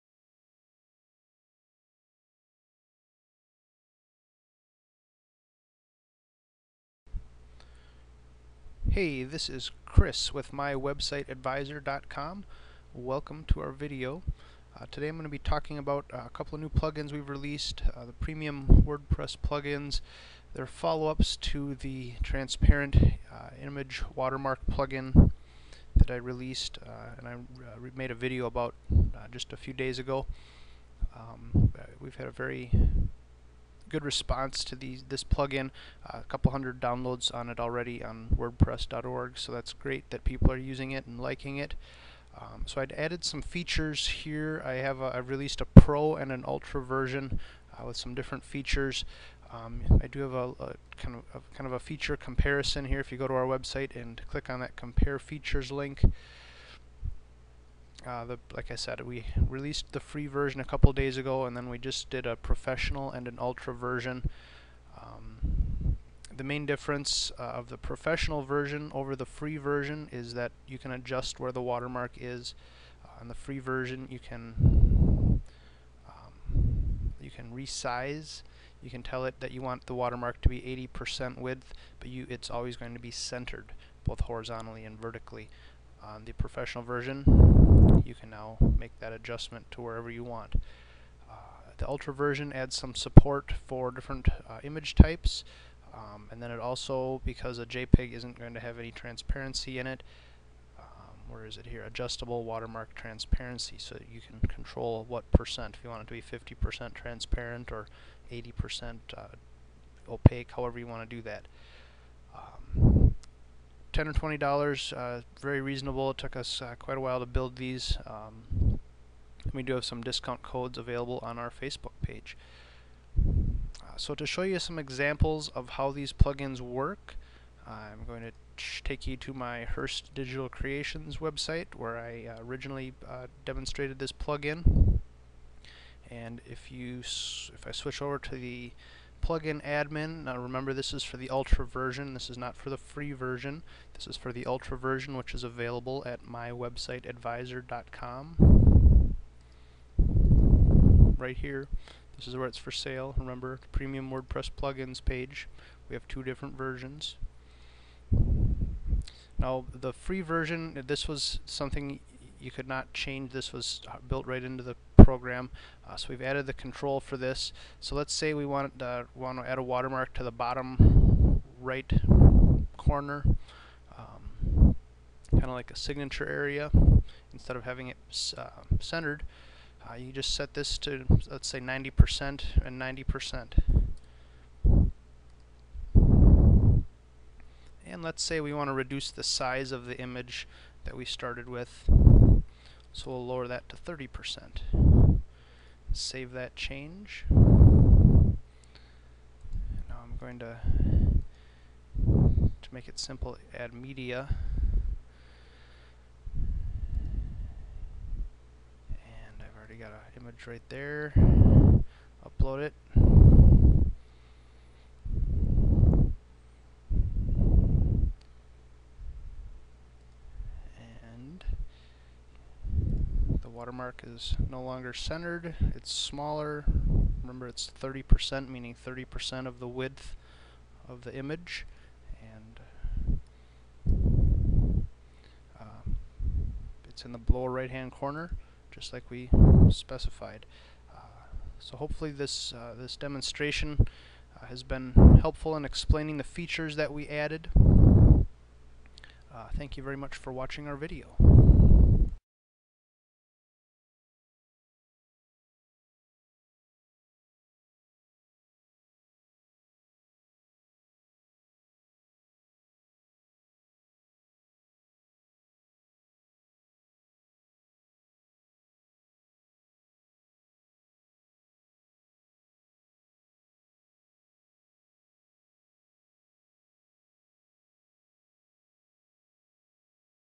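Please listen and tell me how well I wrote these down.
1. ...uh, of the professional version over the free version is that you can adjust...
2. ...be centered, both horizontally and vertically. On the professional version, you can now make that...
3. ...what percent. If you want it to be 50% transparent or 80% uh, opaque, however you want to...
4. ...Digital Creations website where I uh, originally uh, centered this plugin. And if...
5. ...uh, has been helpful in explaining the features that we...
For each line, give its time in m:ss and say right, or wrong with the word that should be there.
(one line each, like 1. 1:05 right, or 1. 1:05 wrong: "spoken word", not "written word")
1. 1:07 right
2. 1:22 right
3. 1:45 right
4. 2:10 wrong: "demonstrated", not "centered"
5. 4:04 right.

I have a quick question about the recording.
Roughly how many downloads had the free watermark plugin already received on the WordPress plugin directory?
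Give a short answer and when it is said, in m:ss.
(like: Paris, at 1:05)
A couple hundred, at 0:36.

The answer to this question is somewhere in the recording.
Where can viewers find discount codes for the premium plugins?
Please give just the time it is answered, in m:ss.
2:01.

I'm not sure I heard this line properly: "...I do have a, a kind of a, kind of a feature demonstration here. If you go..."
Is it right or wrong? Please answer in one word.
wrong.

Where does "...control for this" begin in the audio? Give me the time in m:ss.
2:46.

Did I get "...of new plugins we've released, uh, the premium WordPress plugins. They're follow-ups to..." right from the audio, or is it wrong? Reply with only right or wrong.
right.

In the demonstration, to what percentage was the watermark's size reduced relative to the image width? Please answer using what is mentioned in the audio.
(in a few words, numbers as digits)
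30%.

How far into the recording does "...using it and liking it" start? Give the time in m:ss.
0:40.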